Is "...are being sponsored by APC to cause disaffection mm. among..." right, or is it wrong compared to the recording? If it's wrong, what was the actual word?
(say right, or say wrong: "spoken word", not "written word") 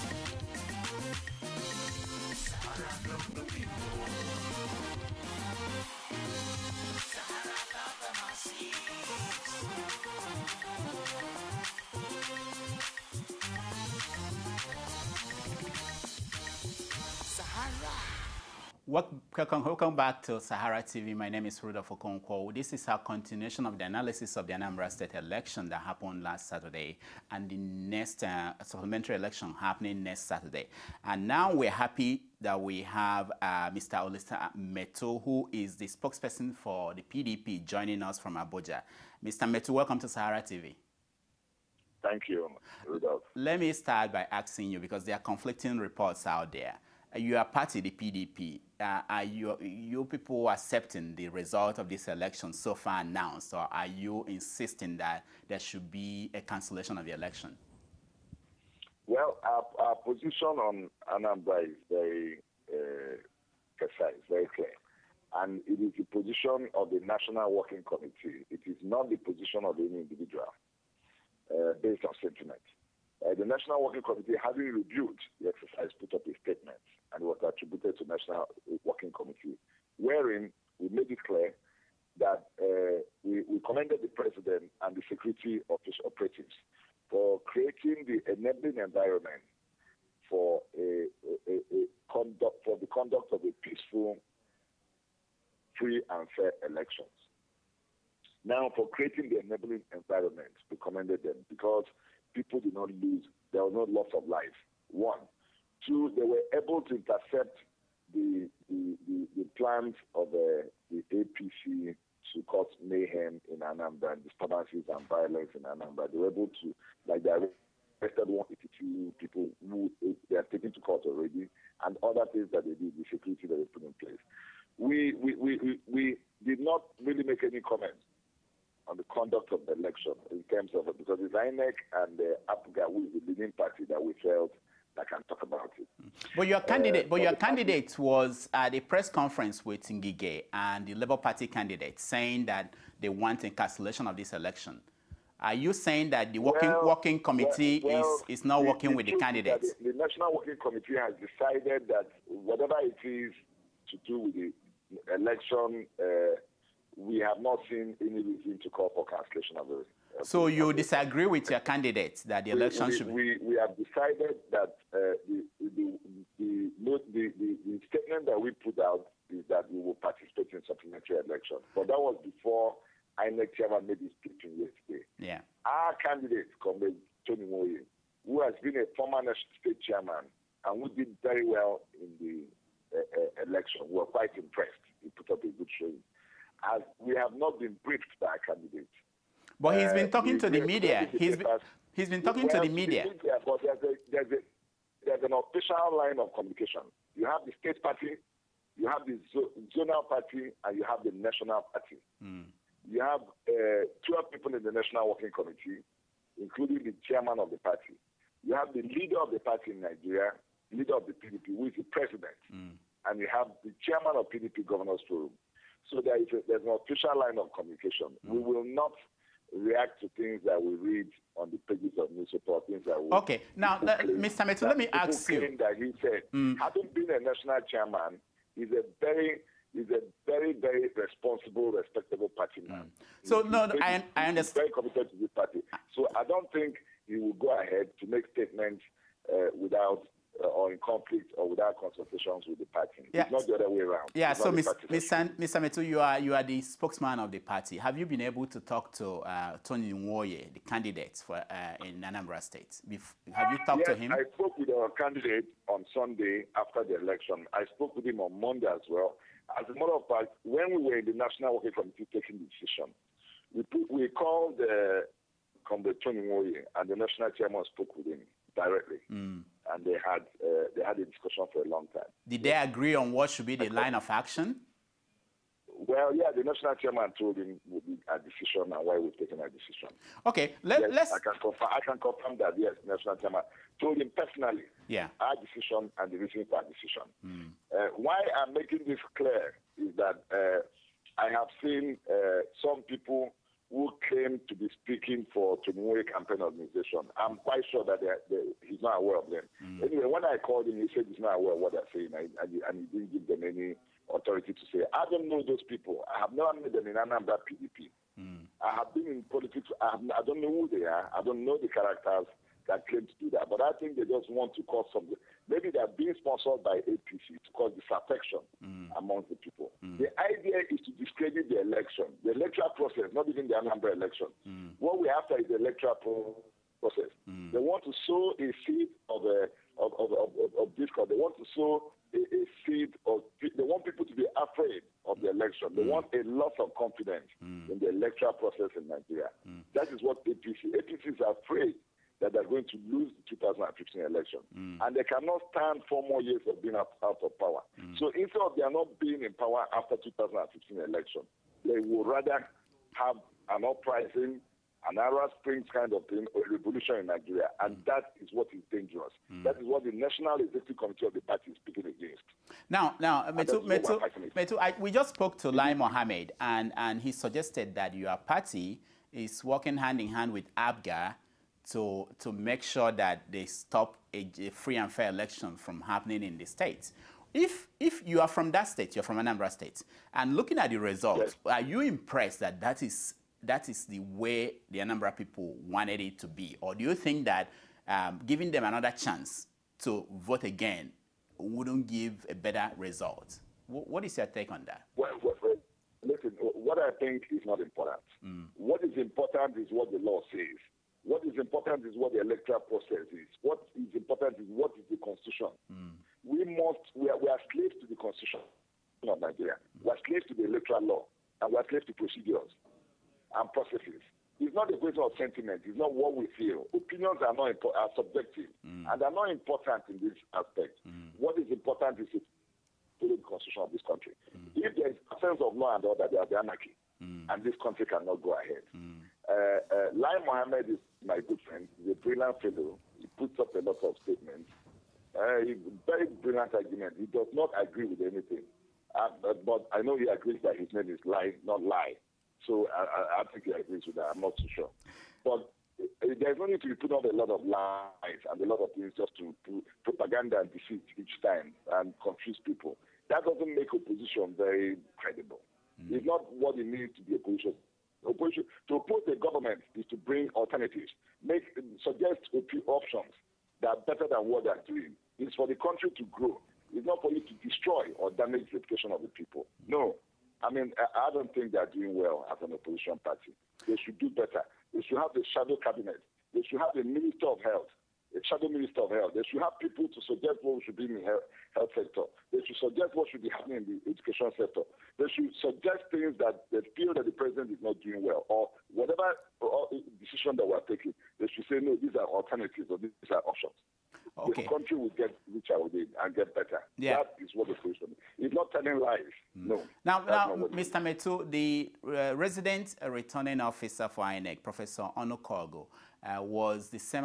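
right.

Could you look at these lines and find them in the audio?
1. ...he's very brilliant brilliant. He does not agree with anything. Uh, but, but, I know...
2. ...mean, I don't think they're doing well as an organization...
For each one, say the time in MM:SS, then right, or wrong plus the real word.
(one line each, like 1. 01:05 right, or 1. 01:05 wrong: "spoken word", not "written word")
1. 07:15 wrong: "argument", not "brilliant"
2. 07:50 wrong: "opposition", not "organization".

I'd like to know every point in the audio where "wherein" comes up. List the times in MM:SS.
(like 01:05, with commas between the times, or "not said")
01:19.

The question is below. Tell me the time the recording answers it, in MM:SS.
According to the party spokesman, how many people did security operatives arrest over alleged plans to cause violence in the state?
01:58.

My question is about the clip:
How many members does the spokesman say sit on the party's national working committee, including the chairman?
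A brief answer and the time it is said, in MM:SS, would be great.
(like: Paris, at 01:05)
12, at 03:24.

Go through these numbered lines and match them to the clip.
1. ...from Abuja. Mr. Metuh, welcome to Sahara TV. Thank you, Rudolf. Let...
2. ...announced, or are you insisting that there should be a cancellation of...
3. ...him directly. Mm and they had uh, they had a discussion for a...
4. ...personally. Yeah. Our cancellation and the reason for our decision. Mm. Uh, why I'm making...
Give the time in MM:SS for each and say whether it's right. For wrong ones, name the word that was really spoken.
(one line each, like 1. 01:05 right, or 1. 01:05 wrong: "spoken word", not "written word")
1. 00:38 right
2. 00:53 right
3. 04:28 right
4. 04:44 wrong: "decision", not "cancellation".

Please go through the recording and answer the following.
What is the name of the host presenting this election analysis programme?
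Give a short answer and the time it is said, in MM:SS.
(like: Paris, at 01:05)
Rudolf Okonkwo, at 00:21.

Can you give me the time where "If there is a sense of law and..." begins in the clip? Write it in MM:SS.
07:04.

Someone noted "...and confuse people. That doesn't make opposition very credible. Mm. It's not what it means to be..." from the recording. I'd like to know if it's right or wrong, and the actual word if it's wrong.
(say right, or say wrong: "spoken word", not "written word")
right.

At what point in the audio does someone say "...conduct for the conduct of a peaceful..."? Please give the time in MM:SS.
01:32.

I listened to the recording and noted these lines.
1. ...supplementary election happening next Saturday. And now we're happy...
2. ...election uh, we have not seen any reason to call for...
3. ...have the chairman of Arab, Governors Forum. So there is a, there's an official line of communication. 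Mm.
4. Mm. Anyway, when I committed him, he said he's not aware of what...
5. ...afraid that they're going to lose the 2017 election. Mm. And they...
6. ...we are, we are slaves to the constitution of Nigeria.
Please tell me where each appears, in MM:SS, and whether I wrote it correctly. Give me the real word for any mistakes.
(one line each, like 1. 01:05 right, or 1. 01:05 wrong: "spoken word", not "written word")
1. 00:28 right
2. 02:35 right
3. 03:33 wrong: "PDP", not "Arab"
4. 04:59 wrong: "called", not "committed"
5. 05:41 wrong: "2015", not "2017"
6. 06:46 right.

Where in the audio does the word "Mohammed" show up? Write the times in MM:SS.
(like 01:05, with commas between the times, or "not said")
06:05, 07:10.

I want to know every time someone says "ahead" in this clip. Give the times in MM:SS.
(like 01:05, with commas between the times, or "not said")
03:57, 07:08.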